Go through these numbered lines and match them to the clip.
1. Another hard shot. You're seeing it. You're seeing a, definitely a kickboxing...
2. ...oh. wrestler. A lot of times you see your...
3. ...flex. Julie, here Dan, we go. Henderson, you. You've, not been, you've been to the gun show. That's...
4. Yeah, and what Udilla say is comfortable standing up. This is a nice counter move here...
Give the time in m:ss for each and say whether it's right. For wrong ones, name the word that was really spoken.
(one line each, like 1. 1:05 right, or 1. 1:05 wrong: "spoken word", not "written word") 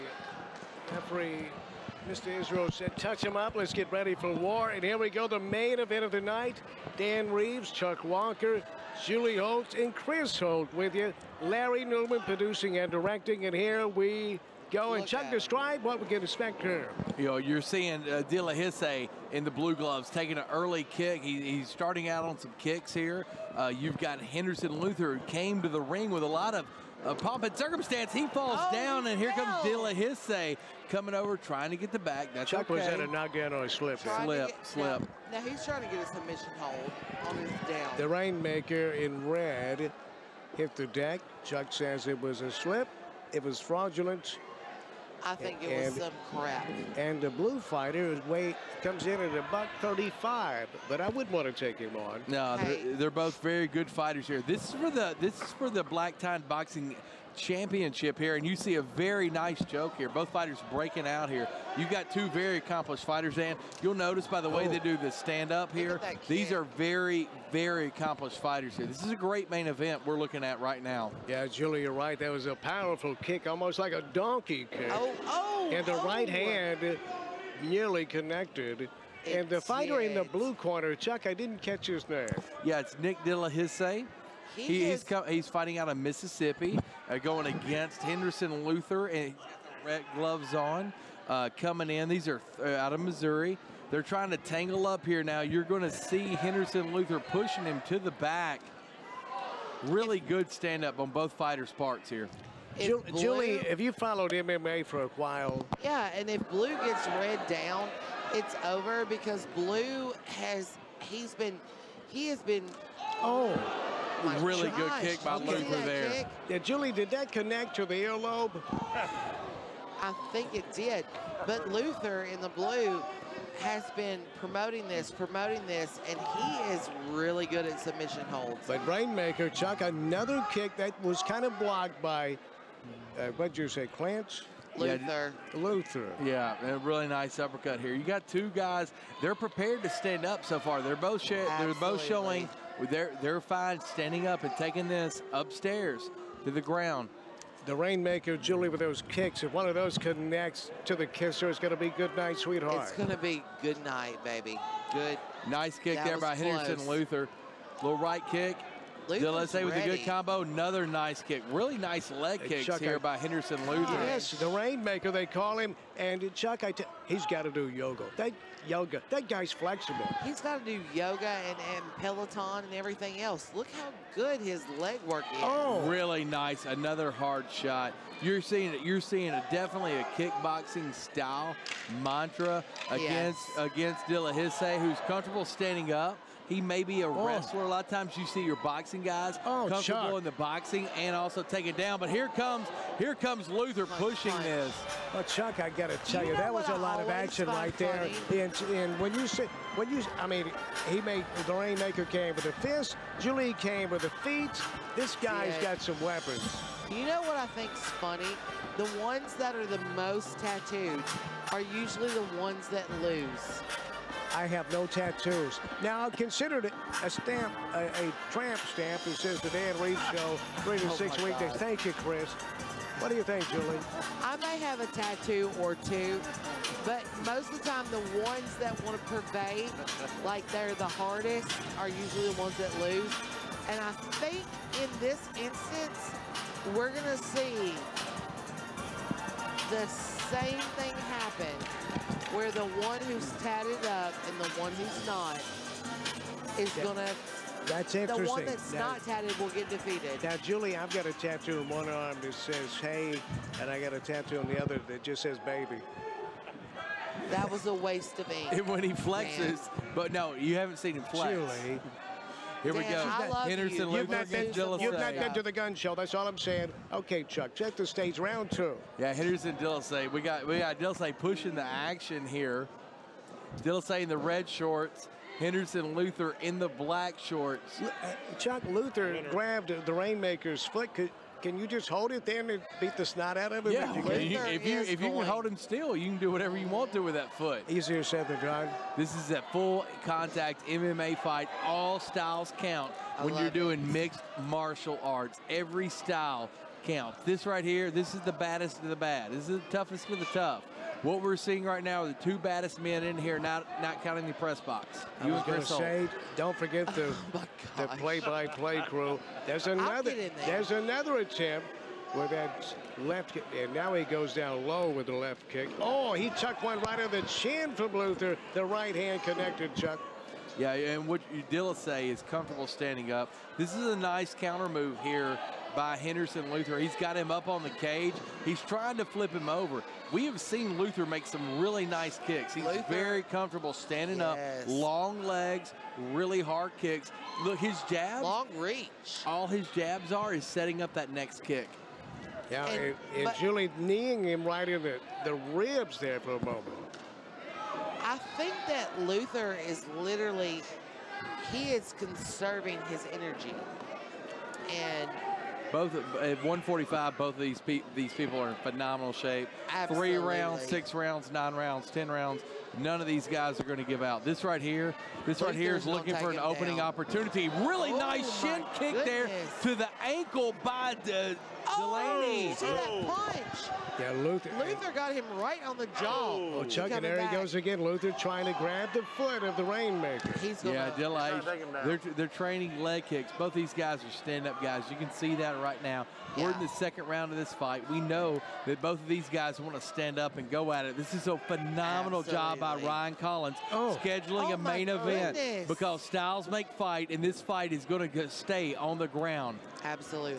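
1. 2:56 right
2. 3:07 right
3. 4:21 right
4. 5:20 right.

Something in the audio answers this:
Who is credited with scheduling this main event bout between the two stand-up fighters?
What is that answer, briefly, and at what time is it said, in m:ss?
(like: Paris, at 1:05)
Ryan Collins, at 6:32.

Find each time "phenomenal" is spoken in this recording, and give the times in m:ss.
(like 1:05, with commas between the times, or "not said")
5:58, 6:31.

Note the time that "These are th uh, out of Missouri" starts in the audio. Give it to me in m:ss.
1:32.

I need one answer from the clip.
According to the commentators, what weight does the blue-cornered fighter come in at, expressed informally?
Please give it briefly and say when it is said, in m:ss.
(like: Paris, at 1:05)
a buck 35, at 0:49.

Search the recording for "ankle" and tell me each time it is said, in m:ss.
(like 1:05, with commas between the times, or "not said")
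6:10.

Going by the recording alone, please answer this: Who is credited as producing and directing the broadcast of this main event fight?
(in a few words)
Larry Newman.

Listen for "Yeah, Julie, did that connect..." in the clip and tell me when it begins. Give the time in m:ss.
1:56.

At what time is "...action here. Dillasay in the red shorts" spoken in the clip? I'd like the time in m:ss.
4:31.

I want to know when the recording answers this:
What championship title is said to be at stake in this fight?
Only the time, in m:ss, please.
0:55.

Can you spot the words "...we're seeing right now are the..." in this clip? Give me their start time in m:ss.
5:01.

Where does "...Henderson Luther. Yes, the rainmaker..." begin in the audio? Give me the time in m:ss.
2:43.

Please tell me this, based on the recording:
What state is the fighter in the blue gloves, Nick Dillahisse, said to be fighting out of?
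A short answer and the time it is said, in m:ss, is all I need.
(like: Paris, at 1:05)
Mississippi, at 1:25.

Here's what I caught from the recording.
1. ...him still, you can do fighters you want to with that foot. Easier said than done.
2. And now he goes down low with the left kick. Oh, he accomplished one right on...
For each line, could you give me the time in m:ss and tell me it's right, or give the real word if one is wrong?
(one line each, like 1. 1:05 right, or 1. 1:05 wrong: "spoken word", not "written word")
1. 4:45 wrong: "whatever", not "fighters"
2. 5:13 wrong: "chucked", not "accomplished".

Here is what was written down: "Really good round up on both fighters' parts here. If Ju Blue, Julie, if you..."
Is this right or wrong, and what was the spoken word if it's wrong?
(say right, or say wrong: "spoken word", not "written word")
wrong: "stand", not "round".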